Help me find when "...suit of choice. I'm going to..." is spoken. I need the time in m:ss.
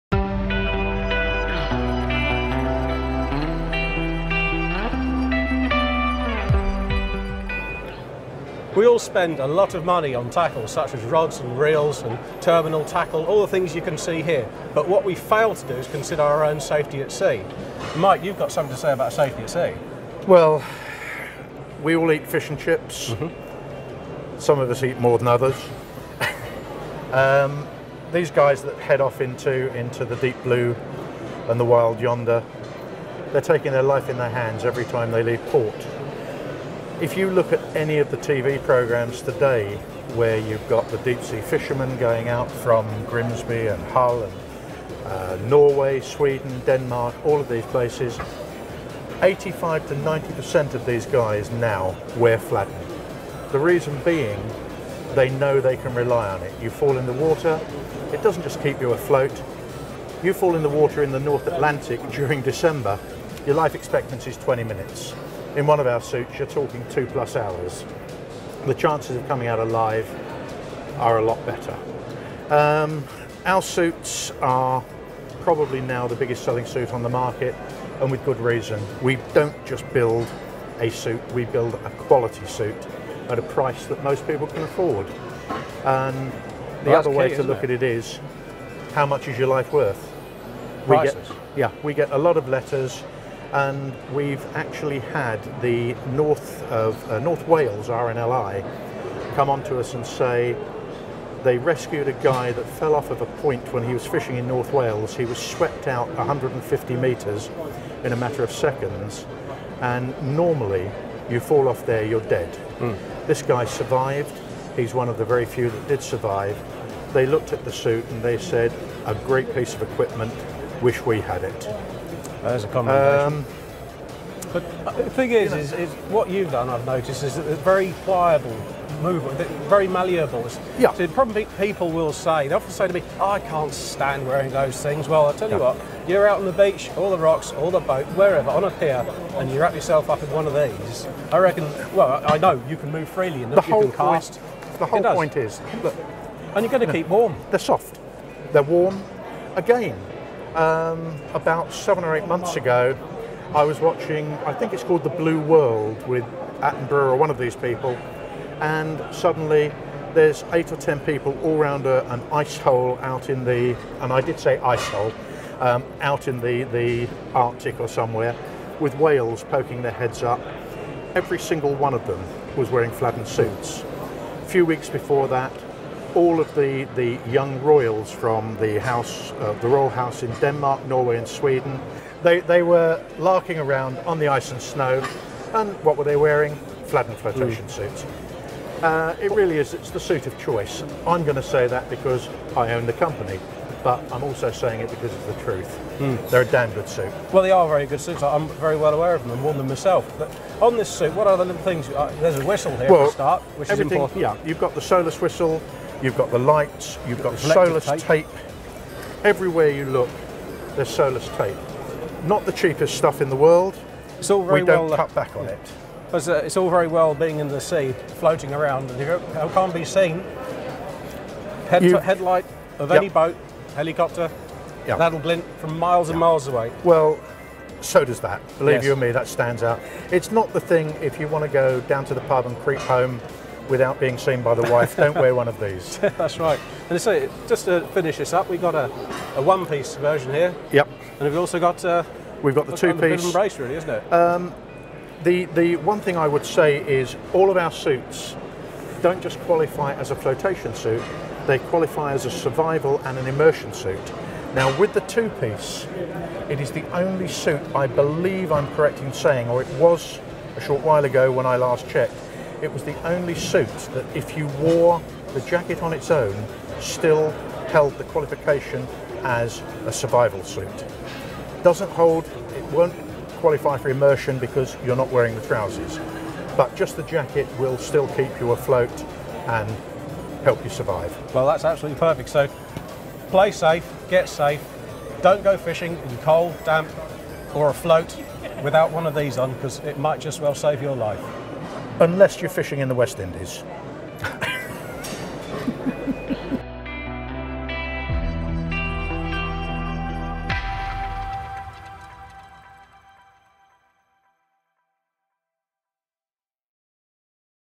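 3:09.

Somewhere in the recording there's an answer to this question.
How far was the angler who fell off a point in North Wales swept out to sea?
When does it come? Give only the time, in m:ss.
1:46.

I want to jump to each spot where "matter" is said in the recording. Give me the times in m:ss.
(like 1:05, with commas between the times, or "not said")
1:48.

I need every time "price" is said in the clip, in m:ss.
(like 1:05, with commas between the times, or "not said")
1:23, 1:30.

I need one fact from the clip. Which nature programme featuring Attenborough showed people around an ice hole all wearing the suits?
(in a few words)
The Blue World.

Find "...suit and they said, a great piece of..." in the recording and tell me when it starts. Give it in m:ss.
1:57.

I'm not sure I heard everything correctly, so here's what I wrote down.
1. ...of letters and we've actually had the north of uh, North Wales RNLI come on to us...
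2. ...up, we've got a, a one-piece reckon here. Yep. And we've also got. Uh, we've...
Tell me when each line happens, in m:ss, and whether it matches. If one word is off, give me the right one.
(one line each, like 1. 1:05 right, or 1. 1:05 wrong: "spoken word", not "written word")
1. 1:32 right
2. 3:58 wrong: "version", not "reckon".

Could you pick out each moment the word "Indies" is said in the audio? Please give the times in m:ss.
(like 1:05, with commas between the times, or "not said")
4:53.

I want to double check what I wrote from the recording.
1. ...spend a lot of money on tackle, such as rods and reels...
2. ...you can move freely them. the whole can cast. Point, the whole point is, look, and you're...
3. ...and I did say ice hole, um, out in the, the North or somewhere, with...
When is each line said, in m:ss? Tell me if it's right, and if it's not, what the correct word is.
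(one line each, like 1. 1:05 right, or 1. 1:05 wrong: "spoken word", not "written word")
1. 0:08 right
2. 2:22 right
3. 2:44 wrong: "Arctic", not "North".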